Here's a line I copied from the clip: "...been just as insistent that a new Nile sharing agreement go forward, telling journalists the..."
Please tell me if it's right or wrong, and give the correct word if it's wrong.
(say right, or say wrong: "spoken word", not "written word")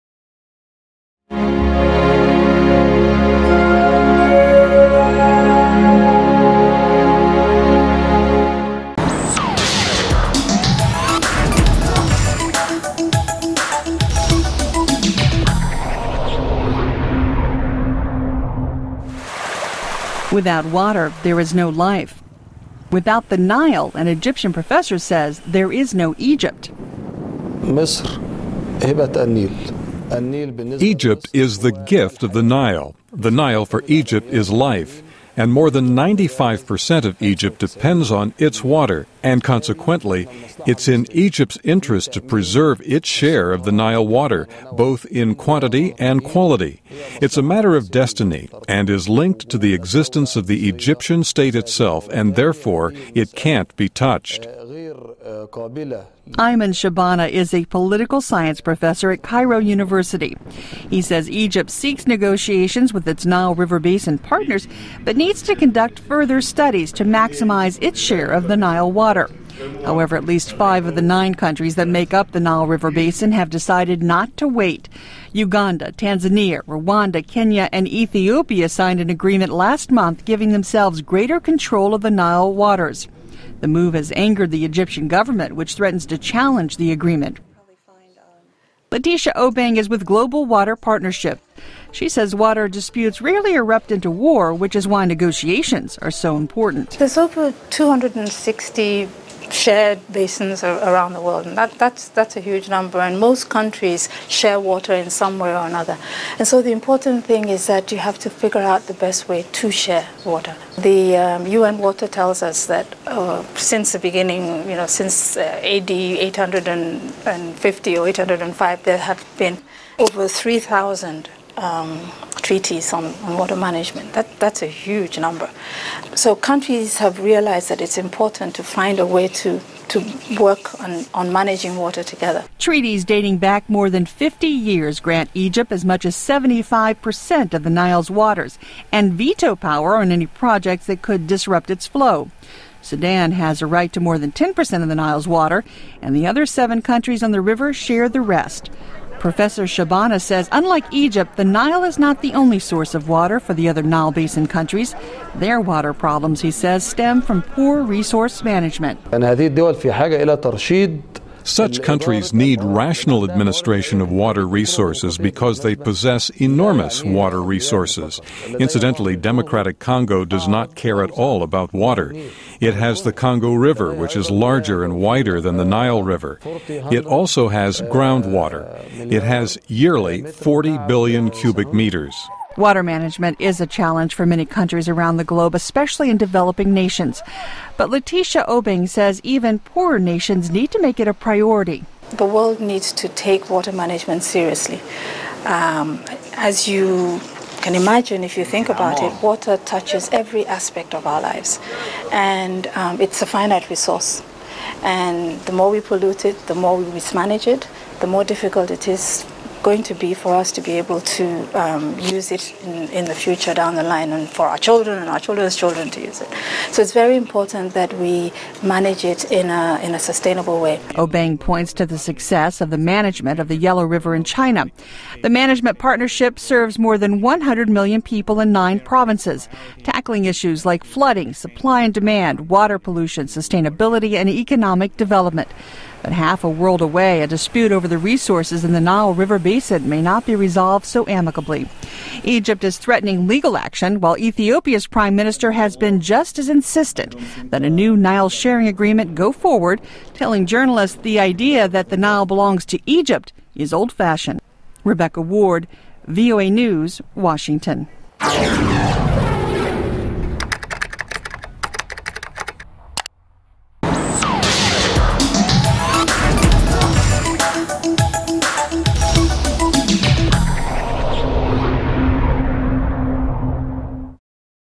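right.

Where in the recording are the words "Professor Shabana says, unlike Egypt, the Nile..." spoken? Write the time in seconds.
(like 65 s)
149 s.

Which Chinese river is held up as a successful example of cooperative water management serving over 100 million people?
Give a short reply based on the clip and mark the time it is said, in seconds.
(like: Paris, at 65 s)
Yellow River, at 223 s.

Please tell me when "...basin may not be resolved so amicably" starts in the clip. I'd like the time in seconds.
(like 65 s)
239 s.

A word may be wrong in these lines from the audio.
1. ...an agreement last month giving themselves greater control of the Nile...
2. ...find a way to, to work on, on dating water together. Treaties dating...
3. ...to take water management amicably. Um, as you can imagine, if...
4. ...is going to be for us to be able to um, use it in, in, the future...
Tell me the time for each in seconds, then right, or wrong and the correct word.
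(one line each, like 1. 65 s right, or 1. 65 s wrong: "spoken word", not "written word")
1. 78 s right
2. 128 s wrong: "managing", not "dating"
3. 192 s wrong: "seriously", not "amicably"
4. 208 s right.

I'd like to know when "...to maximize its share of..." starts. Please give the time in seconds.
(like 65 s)
66 s.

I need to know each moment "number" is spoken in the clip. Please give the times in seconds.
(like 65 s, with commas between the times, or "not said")
102 s, 125 s.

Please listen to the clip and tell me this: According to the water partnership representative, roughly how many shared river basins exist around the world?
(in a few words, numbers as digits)
over 260.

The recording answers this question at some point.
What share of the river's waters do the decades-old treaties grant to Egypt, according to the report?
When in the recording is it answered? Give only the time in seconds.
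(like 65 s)
136 s.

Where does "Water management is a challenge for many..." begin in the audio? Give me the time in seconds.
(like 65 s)
182 s.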